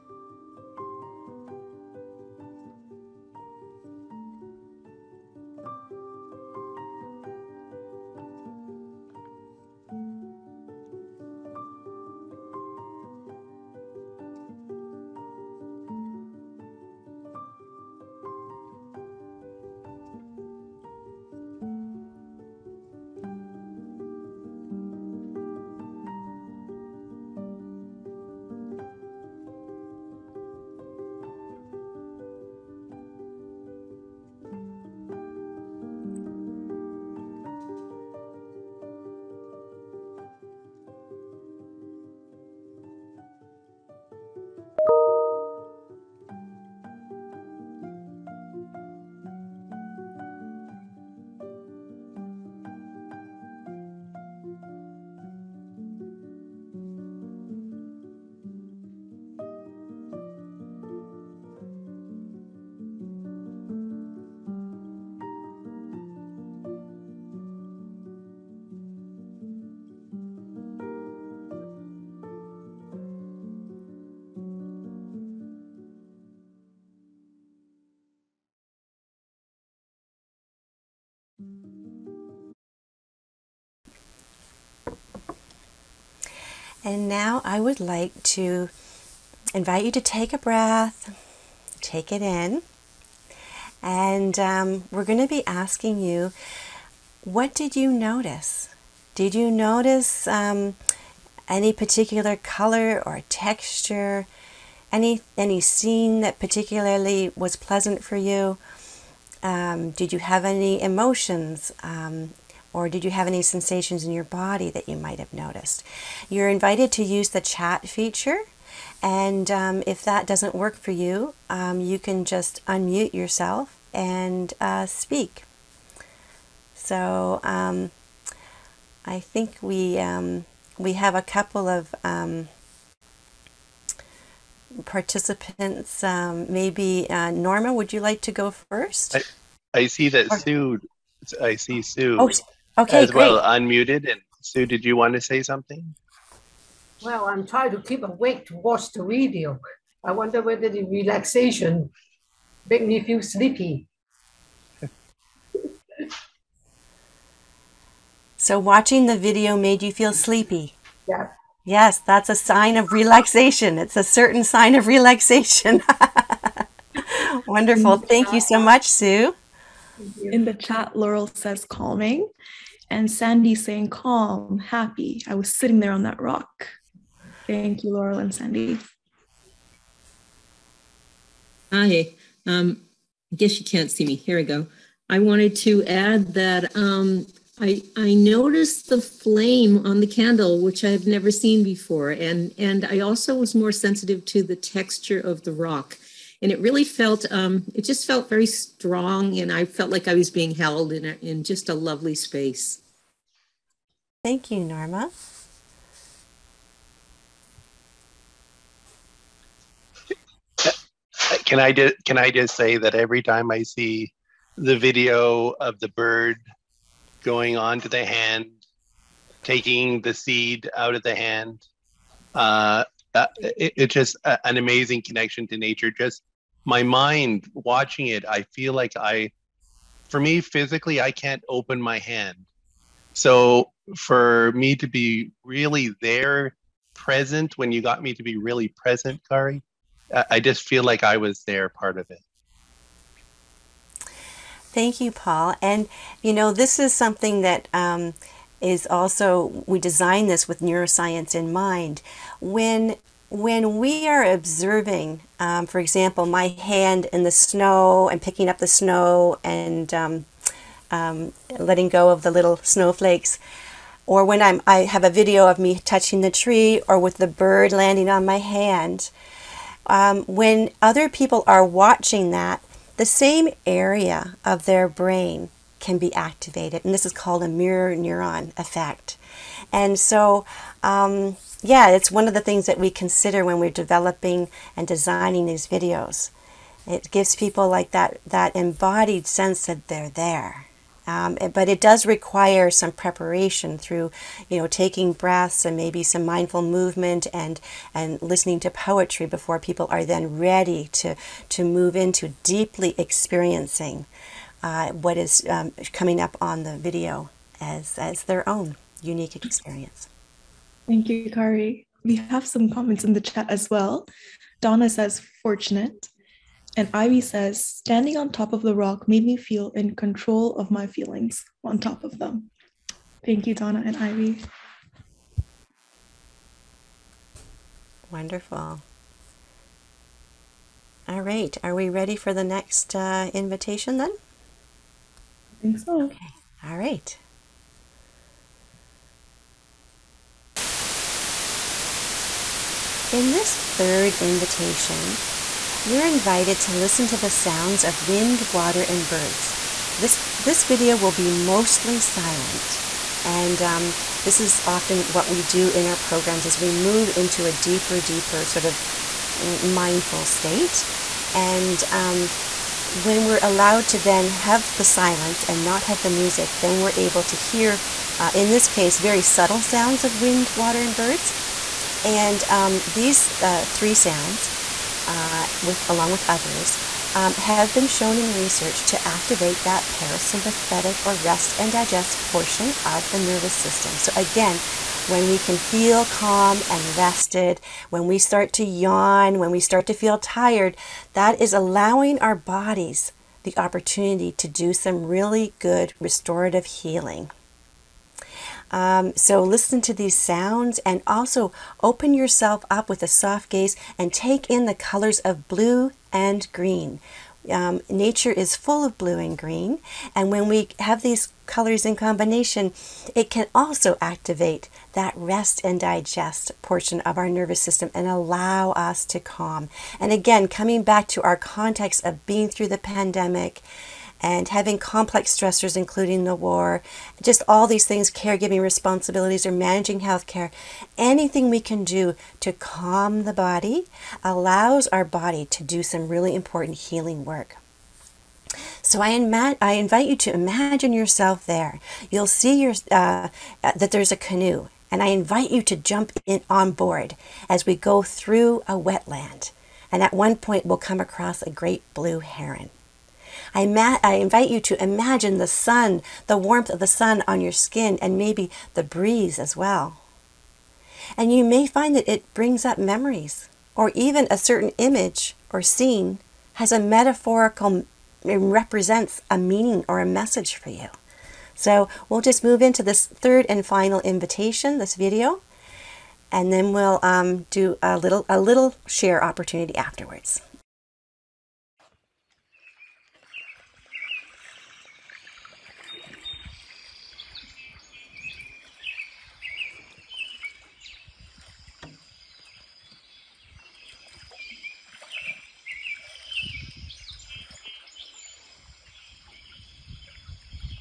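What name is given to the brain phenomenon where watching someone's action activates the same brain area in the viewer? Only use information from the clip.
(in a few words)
mirror neuron effect.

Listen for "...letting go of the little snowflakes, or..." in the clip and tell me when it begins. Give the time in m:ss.
4:21.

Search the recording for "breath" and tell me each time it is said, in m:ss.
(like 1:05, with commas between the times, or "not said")
1:30, 4:55.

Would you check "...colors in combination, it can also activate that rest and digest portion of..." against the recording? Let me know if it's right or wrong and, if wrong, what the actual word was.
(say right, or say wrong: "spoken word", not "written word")
right.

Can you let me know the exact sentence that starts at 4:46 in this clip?
It gives people like that that embodied sense that they're there.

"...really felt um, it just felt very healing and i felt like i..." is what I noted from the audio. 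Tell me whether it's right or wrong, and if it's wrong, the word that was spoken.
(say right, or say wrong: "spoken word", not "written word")
wrong: "strong", not "healing".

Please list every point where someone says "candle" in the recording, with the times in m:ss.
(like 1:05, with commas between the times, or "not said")
3:10.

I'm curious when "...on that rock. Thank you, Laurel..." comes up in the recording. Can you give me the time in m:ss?
2:55.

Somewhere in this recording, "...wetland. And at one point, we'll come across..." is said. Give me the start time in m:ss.
7:28.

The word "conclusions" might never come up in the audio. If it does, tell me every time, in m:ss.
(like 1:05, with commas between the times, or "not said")
not said.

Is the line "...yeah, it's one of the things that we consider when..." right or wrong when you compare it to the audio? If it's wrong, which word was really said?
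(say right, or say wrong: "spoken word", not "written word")
right.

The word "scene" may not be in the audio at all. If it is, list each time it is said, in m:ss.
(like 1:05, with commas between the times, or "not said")
1:45, 7:45.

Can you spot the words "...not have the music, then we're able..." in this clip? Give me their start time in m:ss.
6:05.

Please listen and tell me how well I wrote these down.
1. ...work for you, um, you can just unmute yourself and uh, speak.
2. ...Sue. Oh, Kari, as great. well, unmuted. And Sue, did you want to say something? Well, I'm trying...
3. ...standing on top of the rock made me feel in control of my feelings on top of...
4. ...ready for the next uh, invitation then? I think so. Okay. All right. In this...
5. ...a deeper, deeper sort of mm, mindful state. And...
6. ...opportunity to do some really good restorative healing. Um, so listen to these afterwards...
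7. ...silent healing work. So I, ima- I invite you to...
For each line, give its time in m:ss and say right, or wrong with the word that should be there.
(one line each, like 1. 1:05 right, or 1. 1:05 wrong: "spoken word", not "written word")
1. 2:00 right
2. 2:21 wrong: "Okay", not "Kari"
3. 5:17 right
4. 5:31 right
5. 5:57 right
6. 6:33 wrong: "sounds", not "afterwards"
7. 7:16 wrong: "important", not "silent".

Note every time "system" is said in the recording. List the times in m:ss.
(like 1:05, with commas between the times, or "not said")
6:23, 6:57.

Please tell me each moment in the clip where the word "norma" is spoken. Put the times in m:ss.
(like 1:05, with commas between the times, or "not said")
2:17, 3:24.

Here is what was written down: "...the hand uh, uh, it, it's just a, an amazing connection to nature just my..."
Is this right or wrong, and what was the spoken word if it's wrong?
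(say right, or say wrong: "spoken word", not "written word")
right.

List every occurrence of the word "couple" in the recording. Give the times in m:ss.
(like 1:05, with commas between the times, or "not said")
2:11.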